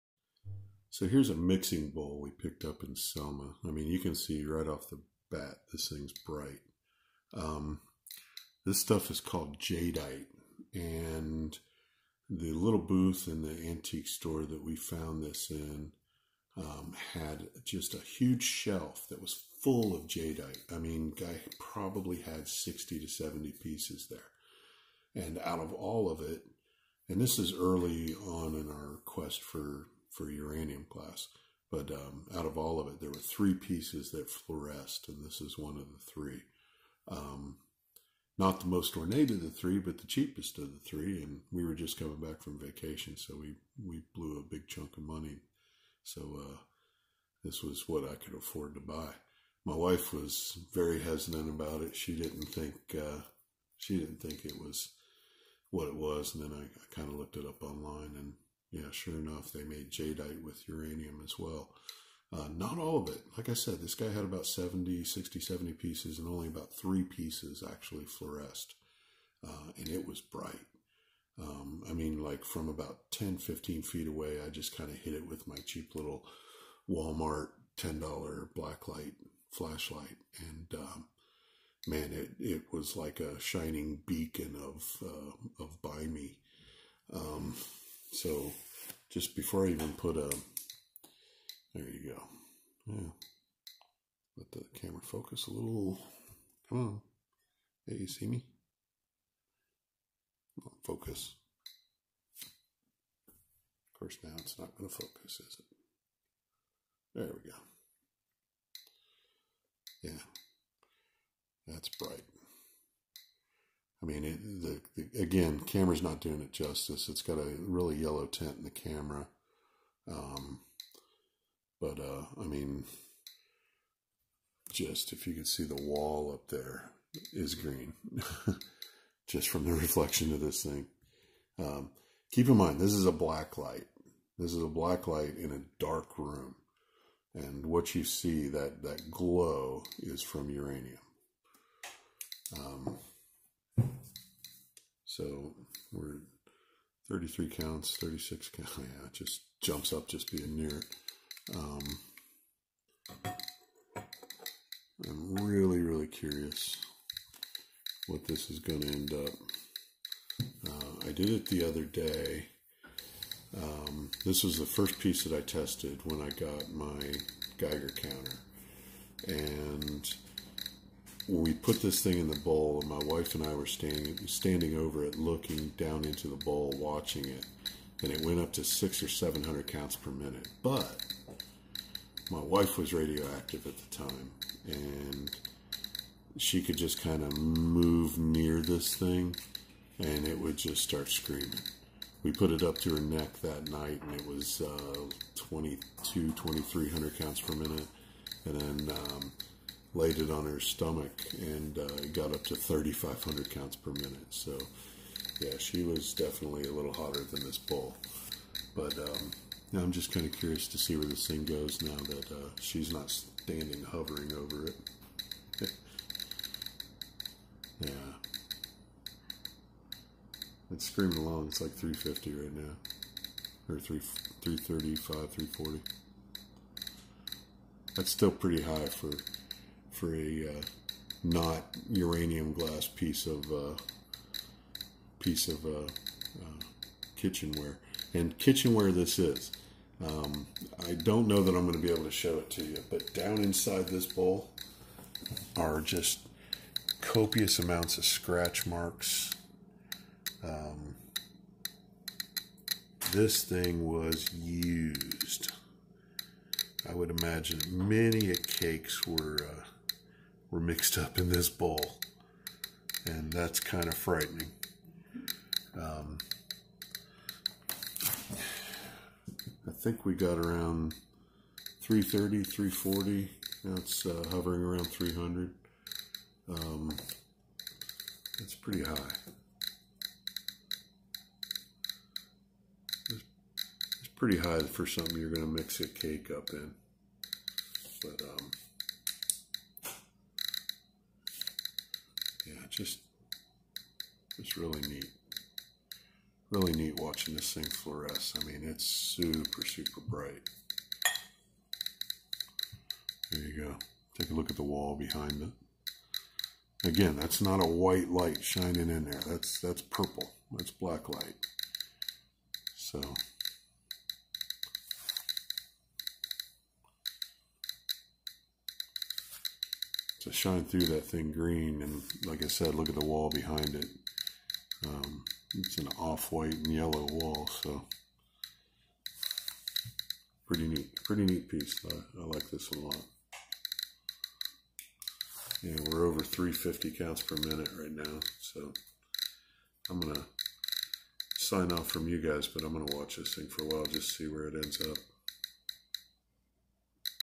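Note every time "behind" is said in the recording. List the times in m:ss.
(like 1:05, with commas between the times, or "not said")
5:04, 5:23.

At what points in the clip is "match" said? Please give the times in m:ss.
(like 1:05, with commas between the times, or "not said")
not said.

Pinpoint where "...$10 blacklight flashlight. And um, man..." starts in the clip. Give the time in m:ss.
1:17.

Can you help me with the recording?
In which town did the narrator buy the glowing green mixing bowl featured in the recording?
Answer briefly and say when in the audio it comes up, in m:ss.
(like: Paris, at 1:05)
Selma, at 0:02.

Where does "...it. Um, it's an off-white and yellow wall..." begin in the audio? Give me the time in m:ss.
5:23.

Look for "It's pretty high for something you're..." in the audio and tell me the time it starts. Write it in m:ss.
4:43.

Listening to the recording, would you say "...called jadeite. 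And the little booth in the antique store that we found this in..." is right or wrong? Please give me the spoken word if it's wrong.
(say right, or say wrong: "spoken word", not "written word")
right.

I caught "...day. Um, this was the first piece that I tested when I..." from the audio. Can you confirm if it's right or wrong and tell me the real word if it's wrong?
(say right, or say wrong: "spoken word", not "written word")
right.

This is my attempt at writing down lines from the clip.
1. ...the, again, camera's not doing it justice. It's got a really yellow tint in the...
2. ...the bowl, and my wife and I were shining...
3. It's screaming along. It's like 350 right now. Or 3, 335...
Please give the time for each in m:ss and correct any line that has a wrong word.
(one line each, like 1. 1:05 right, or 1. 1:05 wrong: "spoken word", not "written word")
1. 1:54 right
2. 2:52 wrong: "standing", not "shining"
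3. 3:40 right.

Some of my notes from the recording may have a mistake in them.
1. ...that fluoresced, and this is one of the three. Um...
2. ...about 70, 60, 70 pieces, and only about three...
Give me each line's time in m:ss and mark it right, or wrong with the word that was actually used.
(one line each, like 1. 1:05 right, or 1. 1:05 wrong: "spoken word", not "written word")
1. 0:34 right
2. 1:04 right.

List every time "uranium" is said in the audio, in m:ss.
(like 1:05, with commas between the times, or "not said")
0:30, 1:00, 2:20, 3:51.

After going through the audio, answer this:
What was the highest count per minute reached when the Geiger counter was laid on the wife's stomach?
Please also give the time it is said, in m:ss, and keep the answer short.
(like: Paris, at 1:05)
3,500, at 3:22.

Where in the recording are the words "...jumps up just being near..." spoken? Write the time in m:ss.
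2:29.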